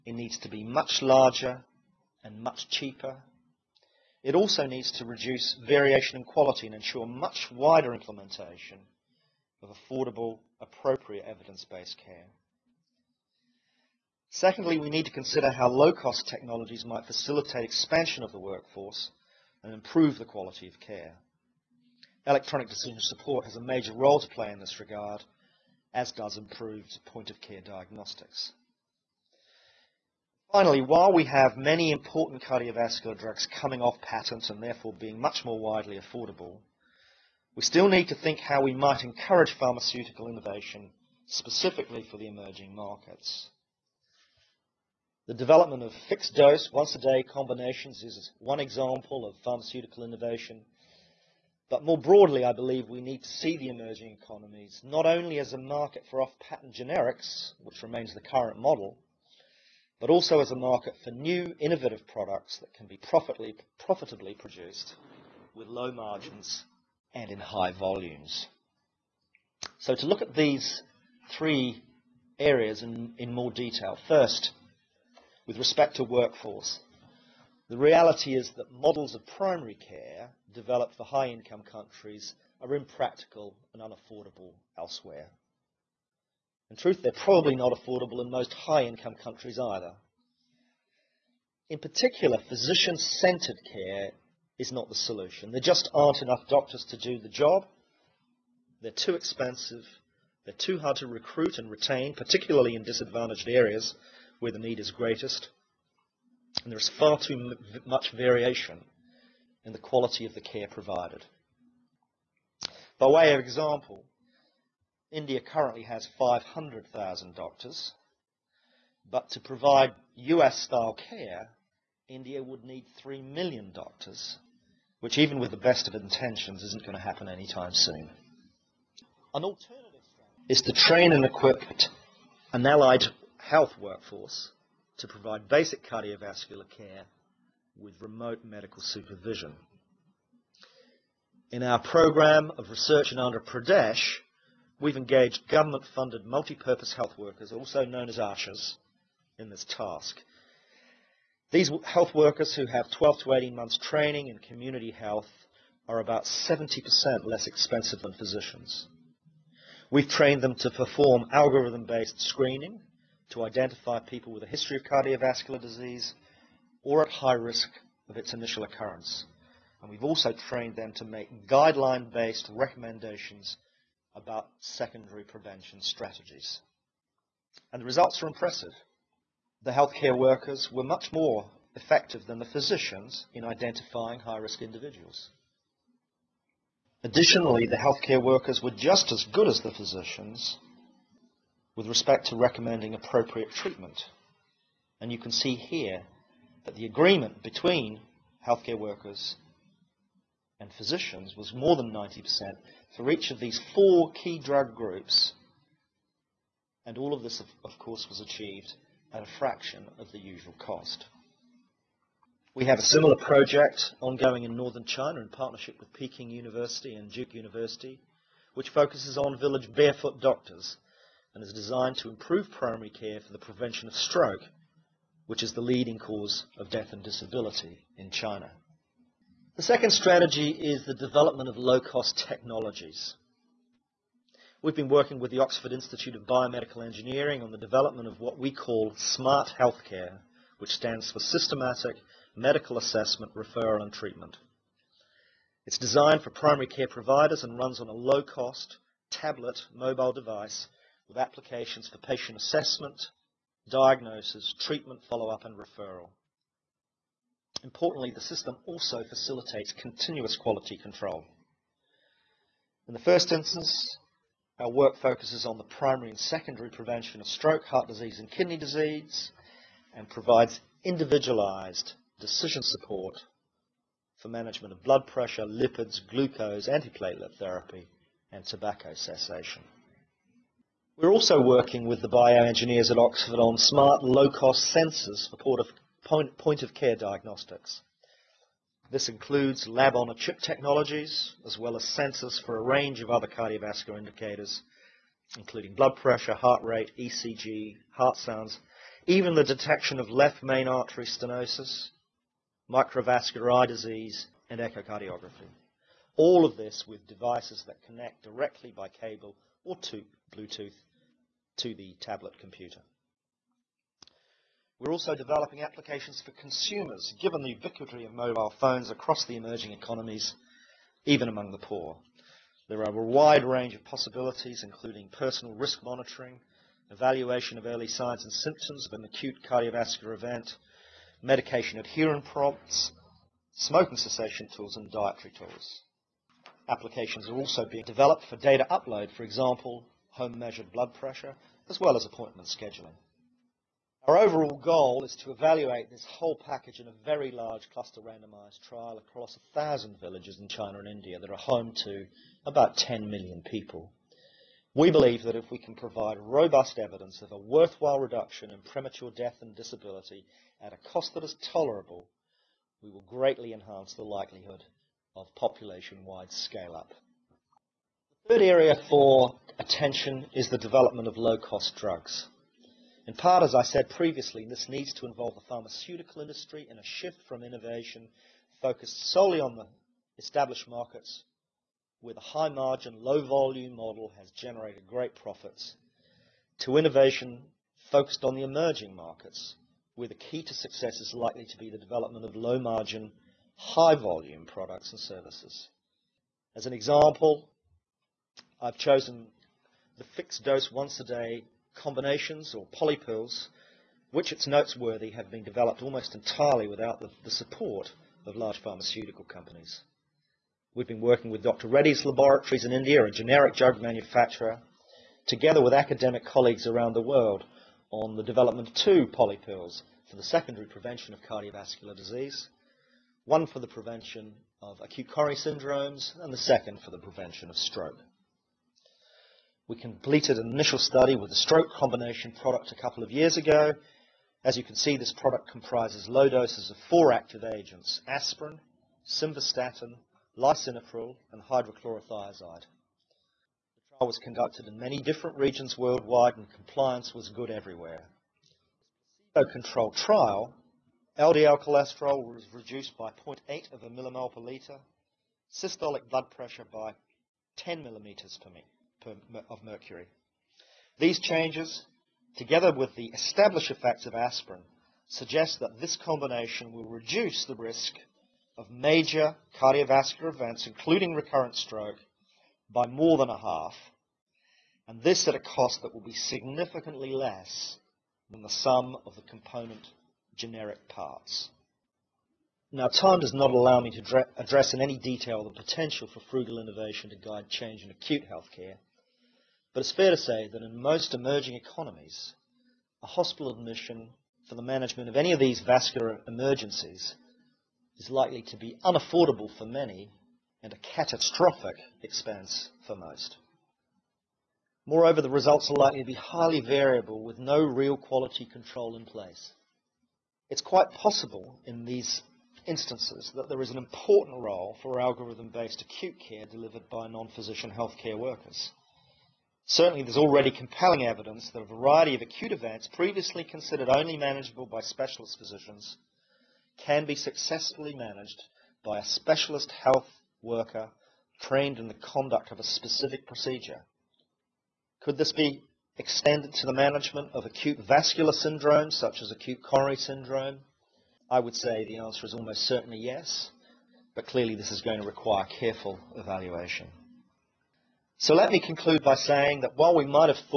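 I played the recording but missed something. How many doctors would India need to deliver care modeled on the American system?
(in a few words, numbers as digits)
3 million.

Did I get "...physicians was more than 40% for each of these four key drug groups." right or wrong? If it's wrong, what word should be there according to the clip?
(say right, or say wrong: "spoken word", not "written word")
wrong: "90", not "40".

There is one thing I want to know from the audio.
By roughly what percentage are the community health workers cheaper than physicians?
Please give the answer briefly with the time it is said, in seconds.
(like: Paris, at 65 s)
70%, at 156 s.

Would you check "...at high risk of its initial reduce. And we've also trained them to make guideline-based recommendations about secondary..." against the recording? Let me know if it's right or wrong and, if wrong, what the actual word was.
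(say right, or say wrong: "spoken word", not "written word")
wrong: "occurrence", not "reduce".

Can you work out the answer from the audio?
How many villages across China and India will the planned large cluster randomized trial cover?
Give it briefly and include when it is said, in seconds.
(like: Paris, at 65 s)
1,000, at 349 s.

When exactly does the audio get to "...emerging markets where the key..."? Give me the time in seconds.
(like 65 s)
388 s.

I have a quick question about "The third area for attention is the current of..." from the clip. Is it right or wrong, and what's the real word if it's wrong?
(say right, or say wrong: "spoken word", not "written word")
wrong: "development", not "current".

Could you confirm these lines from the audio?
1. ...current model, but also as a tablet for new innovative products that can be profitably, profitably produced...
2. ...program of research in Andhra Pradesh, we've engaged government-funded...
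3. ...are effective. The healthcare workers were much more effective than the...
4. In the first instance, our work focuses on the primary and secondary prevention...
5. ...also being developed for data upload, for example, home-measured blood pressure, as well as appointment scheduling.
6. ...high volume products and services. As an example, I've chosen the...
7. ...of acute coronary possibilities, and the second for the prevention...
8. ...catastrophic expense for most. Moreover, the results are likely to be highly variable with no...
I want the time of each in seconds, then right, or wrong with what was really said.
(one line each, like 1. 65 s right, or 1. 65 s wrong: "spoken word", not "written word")
1. 58 s wrong: "market", not "tablet"
2. 141 s right
3. 178 s wrong: "impressive", not "effective"
4. 262 s right
5. 337 s right
6. 393 s right
7. 424 s wrong: "syndromes", not "possibilities"
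8. 500 s right.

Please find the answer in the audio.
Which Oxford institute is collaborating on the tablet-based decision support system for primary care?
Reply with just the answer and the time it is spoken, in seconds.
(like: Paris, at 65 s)
Oxford Institute of Biomedical Engineering, at 235 s.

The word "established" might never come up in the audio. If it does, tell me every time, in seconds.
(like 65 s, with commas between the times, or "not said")
380 s, 463 s.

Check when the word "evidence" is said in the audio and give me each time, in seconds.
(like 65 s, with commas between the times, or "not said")
11 s, 356 s, 521 s.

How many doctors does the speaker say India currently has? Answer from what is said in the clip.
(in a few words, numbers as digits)
500,000.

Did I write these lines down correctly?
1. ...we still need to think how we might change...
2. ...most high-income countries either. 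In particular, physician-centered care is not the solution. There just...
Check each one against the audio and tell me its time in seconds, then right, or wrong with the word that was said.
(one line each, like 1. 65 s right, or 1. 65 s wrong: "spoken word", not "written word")
1. 37 s wrong: "encourage", not "change"
2. 88 s right.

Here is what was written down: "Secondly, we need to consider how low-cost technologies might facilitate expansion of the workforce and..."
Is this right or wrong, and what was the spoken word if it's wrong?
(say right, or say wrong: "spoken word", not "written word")
right.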